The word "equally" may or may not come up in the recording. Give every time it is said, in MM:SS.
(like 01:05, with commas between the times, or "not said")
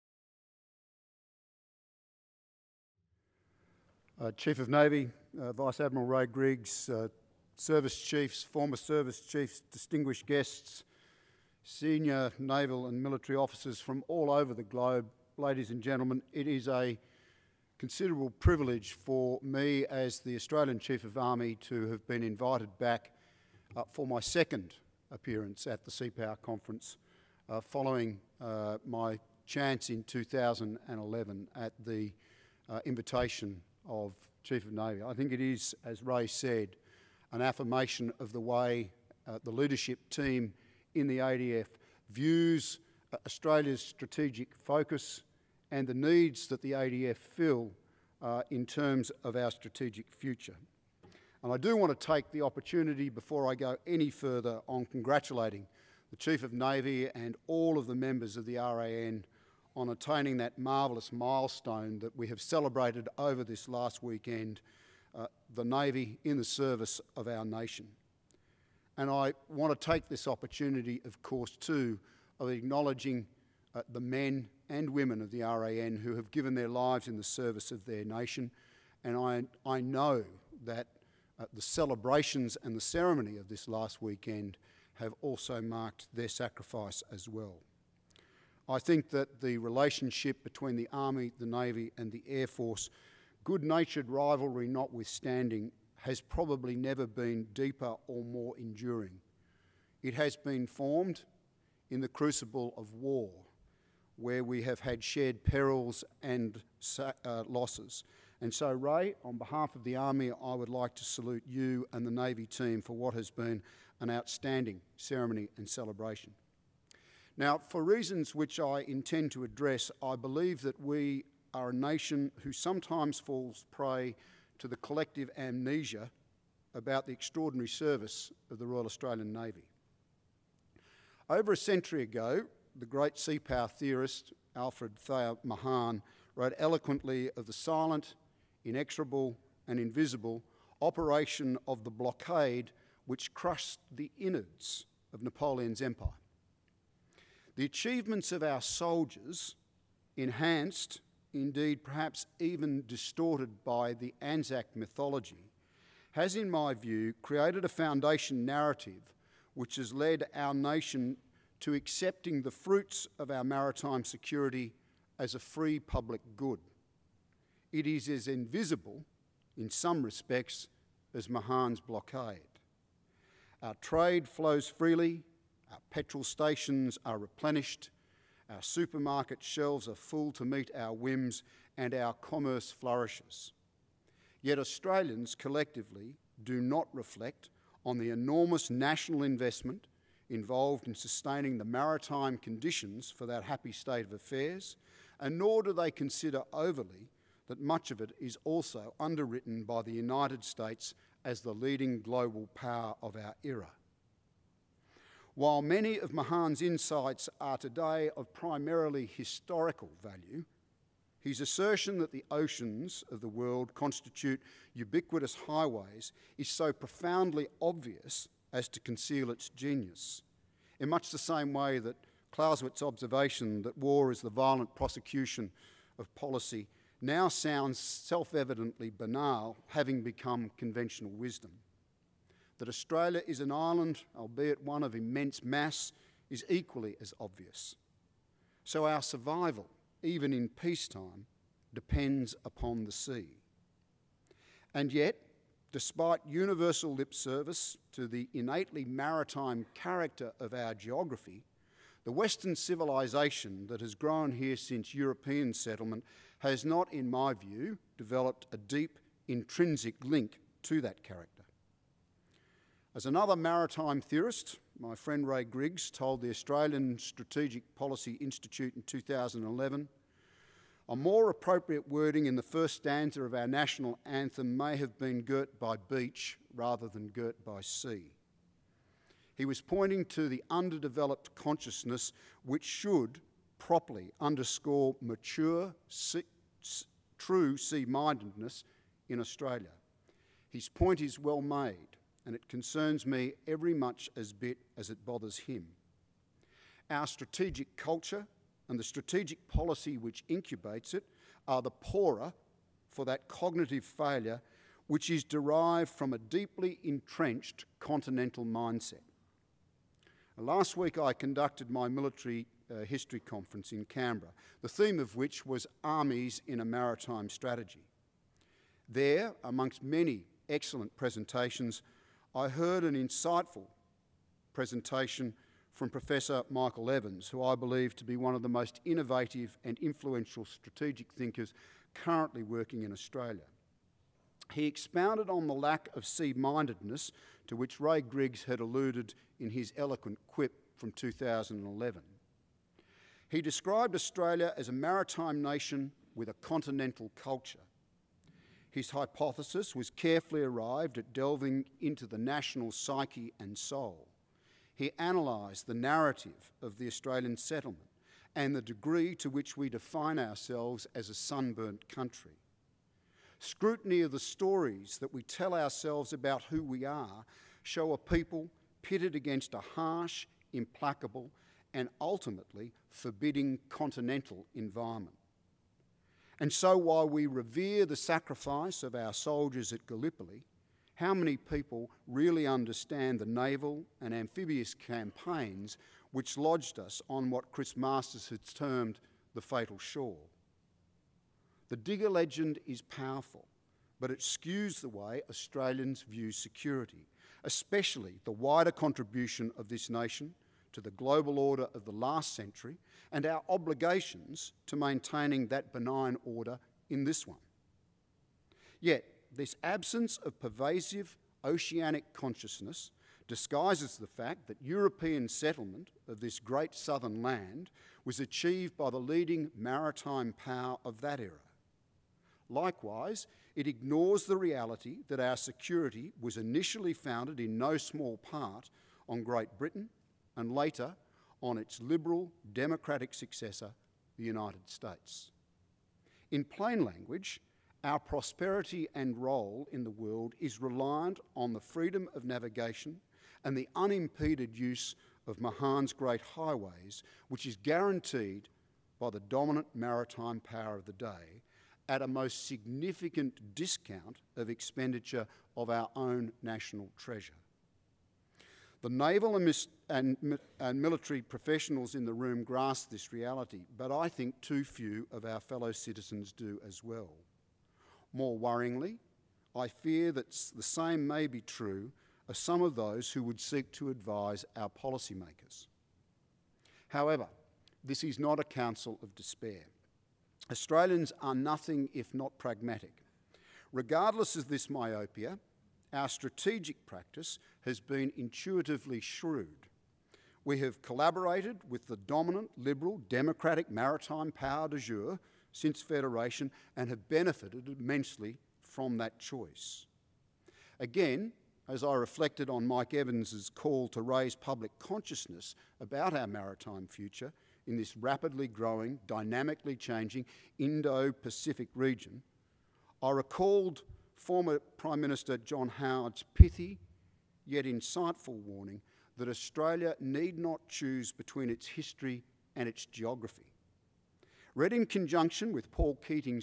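03:56.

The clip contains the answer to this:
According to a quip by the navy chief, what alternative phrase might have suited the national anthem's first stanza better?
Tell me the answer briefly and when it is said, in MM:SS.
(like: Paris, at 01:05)
girt by beach, at 04:35.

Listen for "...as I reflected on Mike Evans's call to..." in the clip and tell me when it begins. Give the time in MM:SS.
08:21.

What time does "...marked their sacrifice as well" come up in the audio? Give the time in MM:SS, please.
01:25.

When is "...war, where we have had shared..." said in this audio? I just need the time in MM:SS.
01:42.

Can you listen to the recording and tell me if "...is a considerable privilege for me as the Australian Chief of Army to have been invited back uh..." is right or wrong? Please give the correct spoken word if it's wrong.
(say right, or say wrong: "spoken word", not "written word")
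right.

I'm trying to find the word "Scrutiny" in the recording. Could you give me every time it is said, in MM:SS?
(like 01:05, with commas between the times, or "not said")
06:03.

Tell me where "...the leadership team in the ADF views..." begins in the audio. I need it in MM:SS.
00:39.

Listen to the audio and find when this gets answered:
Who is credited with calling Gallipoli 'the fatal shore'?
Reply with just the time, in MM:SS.
06:27.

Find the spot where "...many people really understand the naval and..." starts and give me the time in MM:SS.
06:21.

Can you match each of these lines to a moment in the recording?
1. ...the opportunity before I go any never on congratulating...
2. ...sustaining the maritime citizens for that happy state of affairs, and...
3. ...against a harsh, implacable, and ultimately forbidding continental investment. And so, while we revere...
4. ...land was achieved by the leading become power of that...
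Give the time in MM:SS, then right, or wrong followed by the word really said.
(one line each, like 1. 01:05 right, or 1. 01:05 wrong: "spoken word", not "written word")
1. 00:52 wrong: "further", not "never"
2. 03:10 wrong: "conditions", not "citizens"
3. 06:09 wrong: "environment", not "investment"
4. 06:57 wrong: "maritime", not "become".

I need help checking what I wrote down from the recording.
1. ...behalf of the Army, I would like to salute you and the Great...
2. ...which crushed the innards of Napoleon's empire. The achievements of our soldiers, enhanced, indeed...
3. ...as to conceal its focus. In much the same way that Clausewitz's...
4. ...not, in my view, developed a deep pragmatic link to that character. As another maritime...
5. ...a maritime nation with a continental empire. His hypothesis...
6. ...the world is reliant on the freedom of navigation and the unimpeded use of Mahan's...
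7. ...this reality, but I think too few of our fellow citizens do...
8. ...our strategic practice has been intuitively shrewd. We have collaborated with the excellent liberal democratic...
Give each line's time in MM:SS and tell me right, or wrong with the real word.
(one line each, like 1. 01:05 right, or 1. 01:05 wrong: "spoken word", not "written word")
1. 01:49 wrong: "Navy", not "Great"
2. 02:23 right
3. 03:38 wrong: "genius", not "focus"
4. 04:16 wrong: "intrinsic", not "pragmatic"
5. 05:44 wrong: "culture", not "empire"
6. 07:19 right
7. 07:42 right
8. 08:05 wrong: "dominant", not "excellent".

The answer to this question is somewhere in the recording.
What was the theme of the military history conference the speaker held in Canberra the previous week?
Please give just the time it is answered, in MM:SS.
05:15.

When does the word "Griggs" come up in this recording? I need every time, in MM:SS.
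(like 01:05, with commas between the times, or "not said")
00:06, 04:25, 05:38.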